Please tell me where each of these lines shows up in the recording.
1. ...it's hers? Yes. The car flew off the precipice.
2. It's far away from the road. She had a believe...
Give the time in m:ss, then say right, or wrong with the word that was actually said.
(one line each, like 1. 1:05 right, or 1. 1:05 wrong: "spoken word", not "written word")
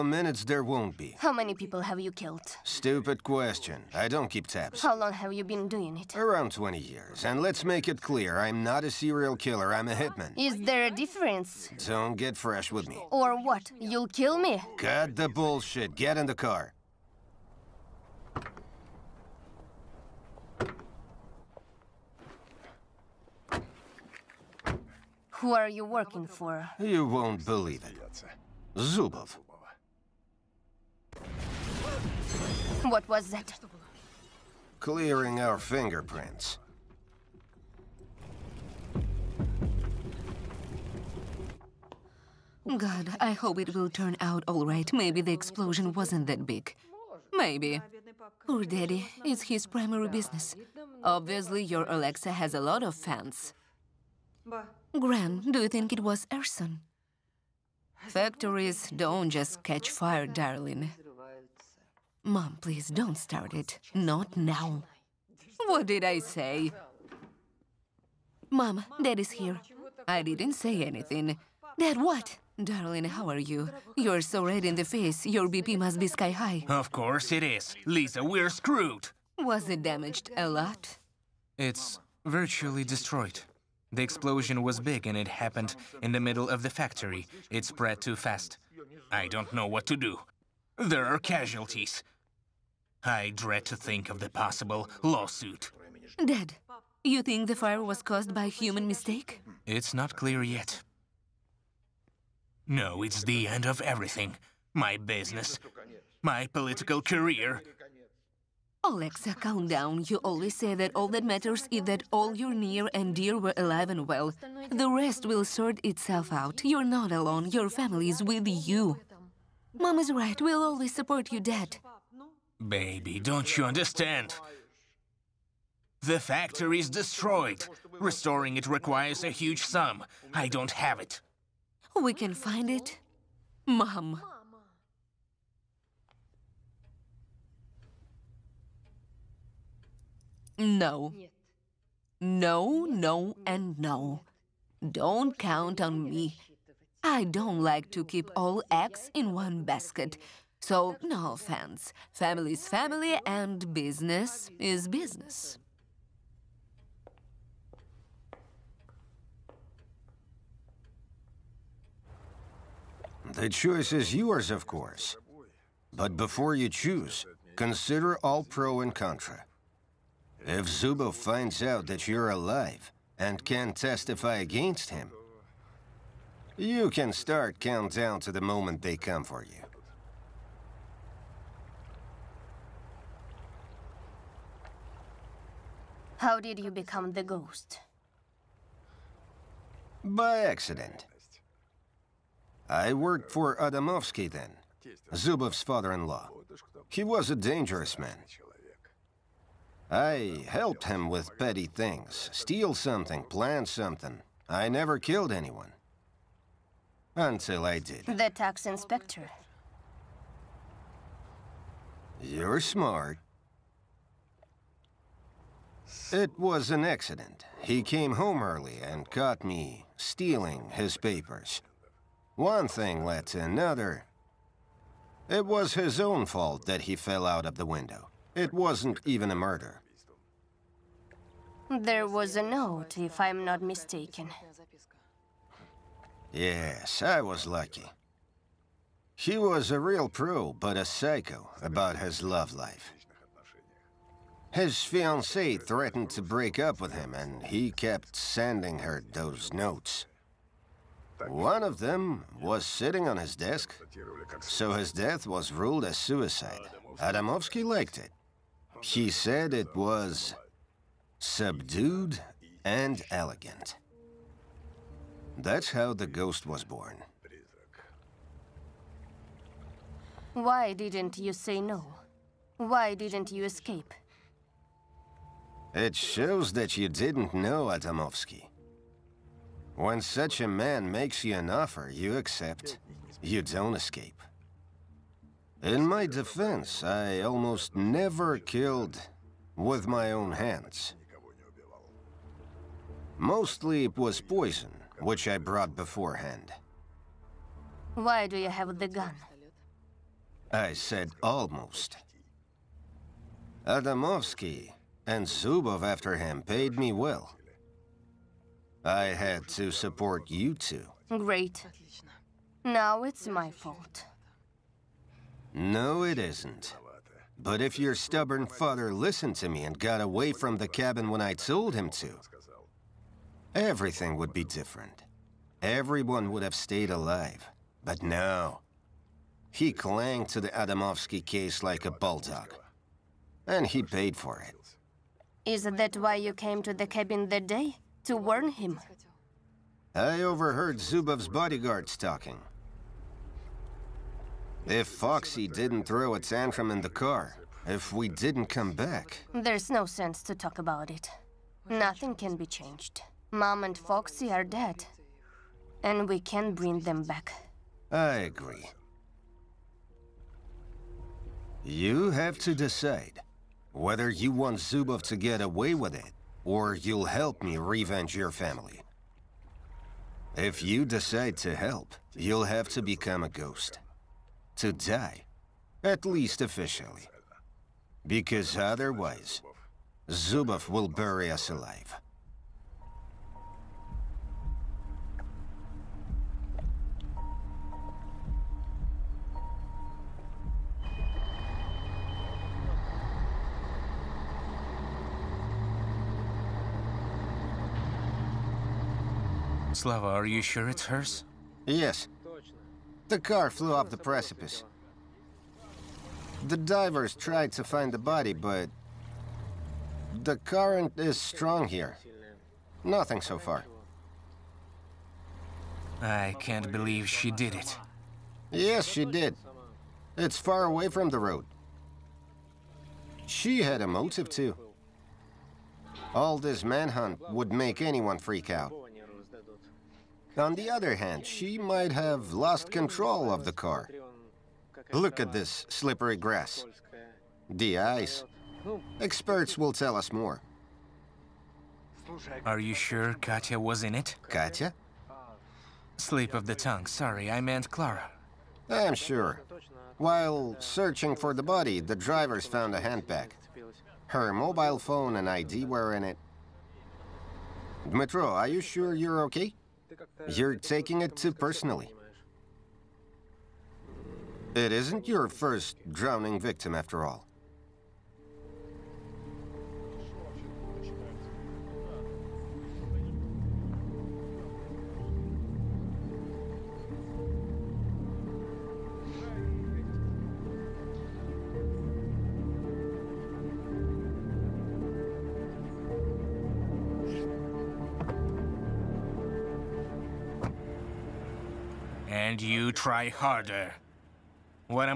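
1. 6:40 right
2. 7:00 wrong: "motive", not "believe".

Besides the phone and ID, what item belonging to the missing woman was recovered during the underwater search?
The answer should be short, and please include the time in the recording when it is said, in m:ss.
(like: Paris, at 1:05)
A handbag, at 7:32.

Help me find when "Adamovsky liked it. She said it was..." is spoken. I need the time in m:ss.
4:17.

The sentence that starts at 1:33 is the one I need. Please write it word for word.
I dread to think of the possible lawsuit.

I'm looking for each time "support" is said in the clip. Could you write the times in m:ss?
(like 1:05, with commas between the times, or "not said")
2:00, 5:09.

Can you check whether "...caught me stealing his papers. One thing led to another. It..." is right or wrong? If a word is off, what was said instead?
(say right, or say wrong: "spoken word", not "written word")
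right.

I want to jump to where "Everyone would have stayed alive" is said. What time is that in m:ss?
5:25.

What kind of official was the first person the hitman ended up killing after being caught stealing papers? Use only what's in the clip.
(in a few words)
Tax inspector.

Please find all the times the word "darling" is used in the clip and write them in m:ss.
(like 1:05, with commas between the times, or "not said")
1:00, 1:12.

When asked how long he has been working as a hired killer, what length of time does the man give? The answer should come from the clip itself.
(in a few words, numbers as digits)
Around 20 years.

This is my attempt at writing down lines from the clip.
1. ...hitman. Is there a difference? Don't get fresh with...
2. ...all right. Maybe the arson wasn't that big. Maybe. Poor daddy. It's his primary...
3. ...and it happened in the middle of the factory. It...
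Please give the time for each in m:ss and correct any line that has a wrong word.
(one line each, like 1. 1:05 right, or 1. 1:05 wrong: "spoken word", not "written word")
1. 0:09 right
2. 0:44 wrong: "explosion", not "arson"
3. 1:25 right.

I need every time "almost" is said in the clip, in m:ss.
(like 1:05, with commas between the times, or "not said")
4:47, 5:01.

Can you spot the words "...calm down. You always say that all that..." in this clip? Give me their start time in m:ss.
1:49.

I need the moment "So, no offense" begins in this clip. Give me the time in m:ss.
2:30.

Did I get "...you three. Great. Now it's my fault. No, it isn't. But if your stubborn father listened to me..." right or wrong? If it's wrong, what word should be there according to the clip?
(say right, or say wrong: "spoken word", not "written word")
wrong: "two", not "three".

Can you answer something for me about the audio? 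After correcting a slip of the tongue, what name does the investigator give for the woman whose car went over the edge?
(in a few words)
Clara.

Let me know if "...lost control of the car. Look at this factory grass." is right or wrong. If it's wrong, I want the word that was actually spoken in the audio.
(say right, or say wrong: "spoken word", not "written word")
wrong: "slippery", not "factory".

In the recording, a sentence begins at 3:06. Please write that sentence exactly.
How did you become the ghost?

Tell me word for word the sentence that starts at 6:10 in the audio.
If you decide to help, you'll have to become a ghost to die, at least officially.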